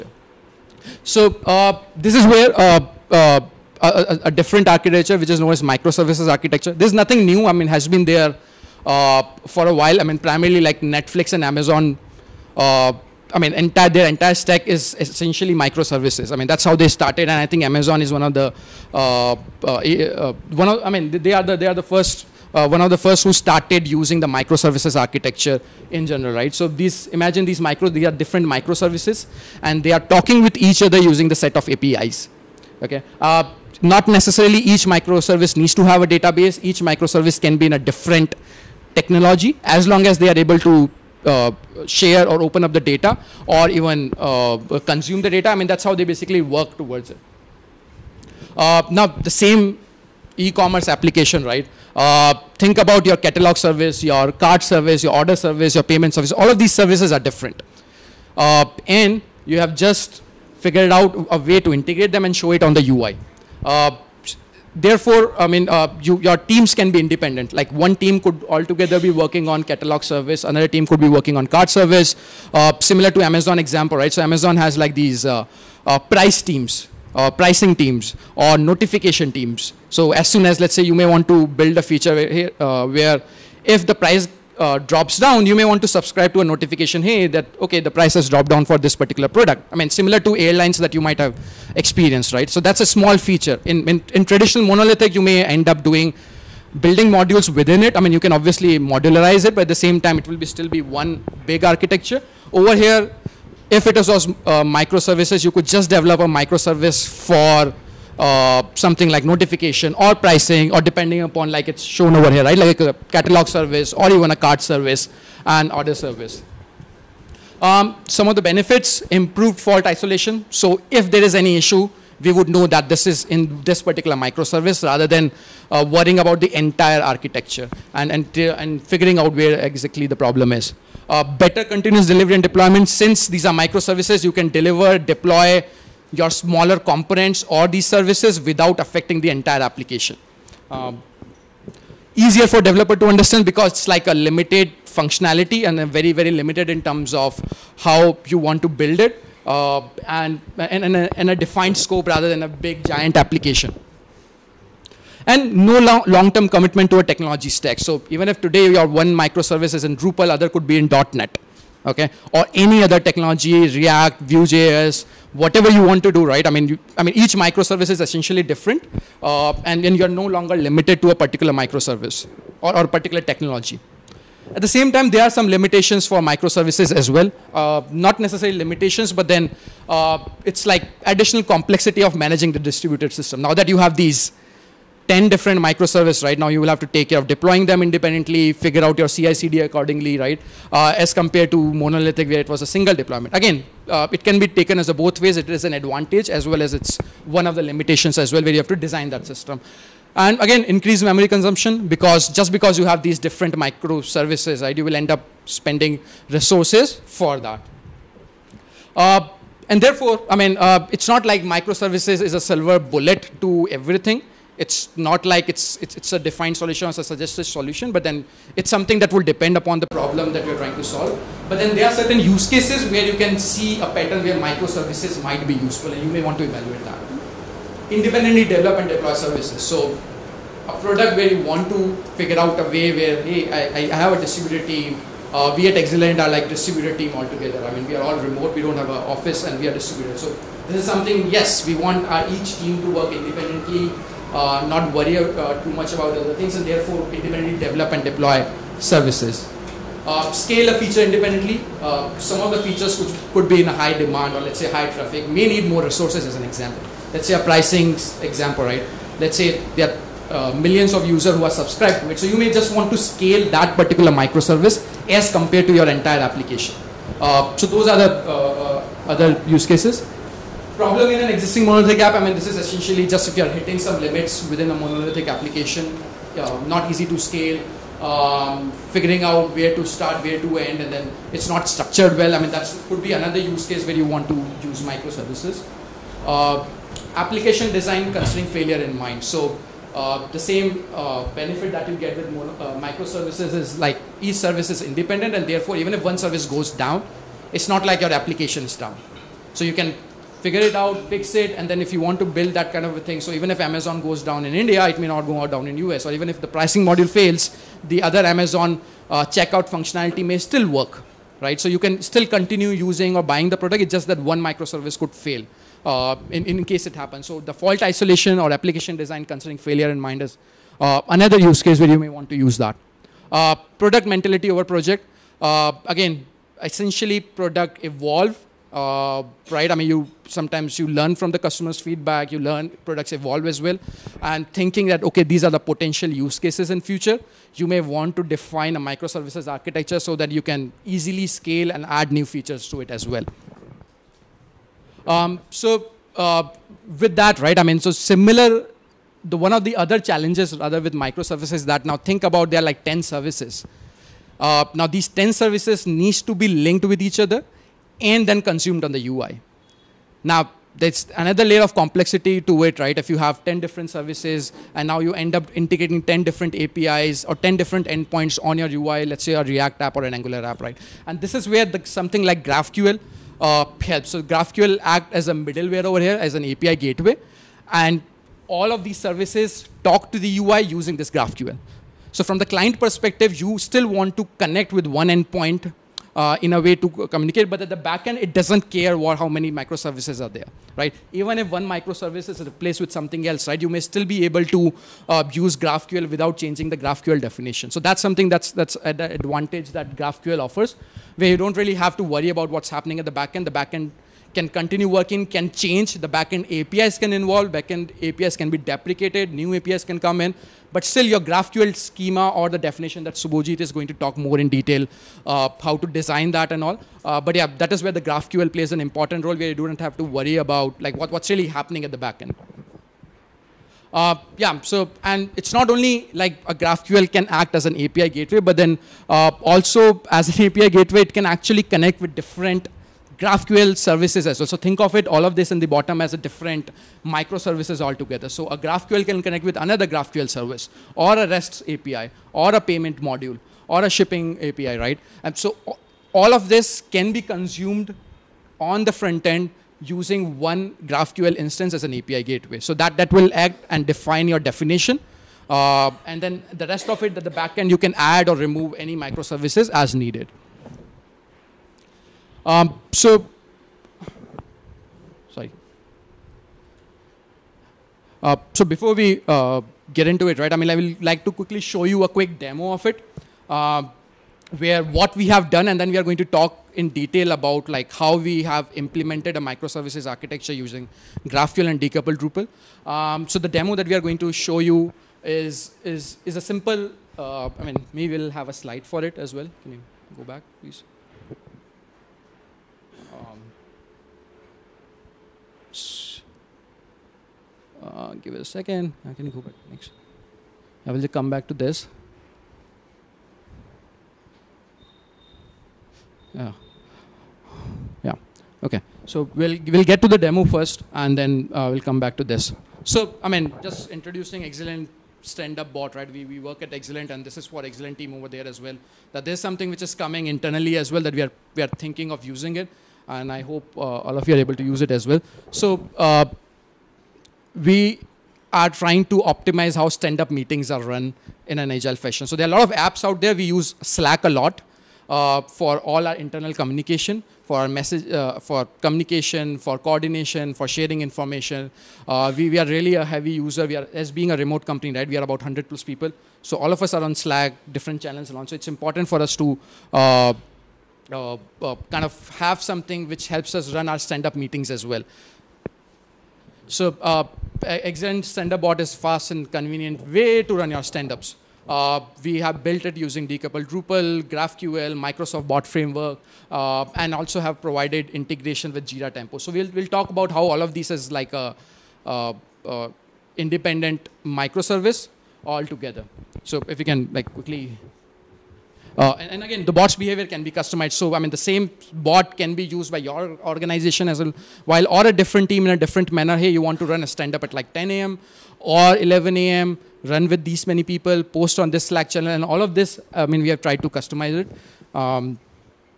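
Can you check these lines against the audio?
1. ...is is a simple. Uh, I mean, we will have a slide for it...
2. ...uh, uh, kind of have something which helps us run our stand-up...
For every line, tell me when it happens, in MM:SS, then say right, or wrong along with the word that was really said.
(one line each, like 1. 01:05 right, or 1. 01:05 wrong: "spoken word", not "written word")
1. 08:05 right
2. 09:11 right.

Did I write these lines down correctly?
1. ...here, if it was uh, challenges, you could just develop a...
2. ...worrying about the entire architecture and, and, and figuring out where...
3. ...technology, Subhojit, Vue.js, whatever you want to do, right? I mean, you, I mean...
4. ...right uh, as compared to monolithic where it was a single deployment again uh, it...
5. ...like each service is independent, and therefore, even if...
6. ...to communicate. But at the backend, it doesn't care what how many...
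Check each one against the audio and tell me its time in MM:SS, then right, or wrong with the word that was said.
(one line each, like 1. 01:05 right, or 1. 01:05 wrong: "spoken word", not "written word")
1. 01:42 wrong: "microservices", not "challenges"
2. 02:05 right
3. 02:43 wrong: "React", not "Subhojit"
4. 03:10 right
5. 04:53 right
6. 06:26 right.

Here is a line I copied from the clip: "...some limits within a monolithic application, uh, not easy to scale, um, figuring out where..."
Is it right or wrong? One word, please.
right.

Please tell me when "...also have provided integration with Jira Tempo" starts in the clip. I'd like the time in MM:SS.
09:27.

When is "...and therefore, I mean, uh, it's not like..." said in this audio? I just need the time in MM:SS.
03:29.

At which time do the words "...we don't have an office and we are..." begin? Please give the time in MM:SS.
03:58.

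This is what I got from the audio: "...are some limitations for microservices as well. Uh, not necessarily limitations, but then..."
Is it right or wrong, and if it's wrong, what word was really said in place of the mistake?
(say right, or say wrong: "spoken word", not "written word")
right.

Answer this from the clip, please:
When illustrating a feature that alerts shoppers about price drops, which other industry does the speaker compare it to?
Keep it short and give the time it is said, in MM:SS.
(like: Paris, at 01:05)
airlines, at 01:30.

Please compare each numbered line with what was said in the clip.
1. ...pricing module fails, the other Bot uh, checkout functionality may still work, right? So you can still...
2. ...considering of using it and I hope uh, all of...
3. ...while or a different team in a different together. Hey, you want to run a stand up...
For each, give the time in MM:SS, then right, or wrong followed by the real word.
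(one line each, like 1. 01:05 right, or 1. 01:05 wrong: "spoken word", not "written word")
1. 05:06 wrong: "Amazon", not "Bot"
2. 08:41 wrong: "thinking", not "considering"
3. 09:44 wrong: "manner", not "together".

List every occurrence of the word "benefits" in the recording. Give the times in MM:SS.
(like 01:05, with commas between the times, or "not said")
01:58, 04:51.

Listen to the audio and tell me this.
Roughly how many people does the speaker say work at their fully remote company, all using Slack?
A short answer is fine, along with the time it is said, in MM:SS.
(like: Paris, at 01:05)
100 plus, at 09:05.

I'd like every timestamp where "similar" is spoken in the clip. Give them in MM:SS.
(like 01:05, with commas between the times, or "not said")
01:12, 01:29, 05:47.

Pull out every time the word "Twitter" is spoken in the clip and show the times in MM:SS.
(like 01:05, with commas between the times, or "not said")
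not said.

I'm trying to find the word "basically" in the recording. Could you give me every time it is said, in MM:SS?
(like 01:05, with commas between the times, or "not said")
00:46.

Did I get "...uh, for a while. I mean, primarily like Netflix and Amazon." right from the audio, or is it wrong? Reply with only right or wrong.
right.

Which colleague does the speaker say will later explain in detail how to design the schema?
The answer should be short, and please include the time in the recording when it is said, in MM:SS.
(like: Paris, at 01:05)
Subhojit, at 06:53.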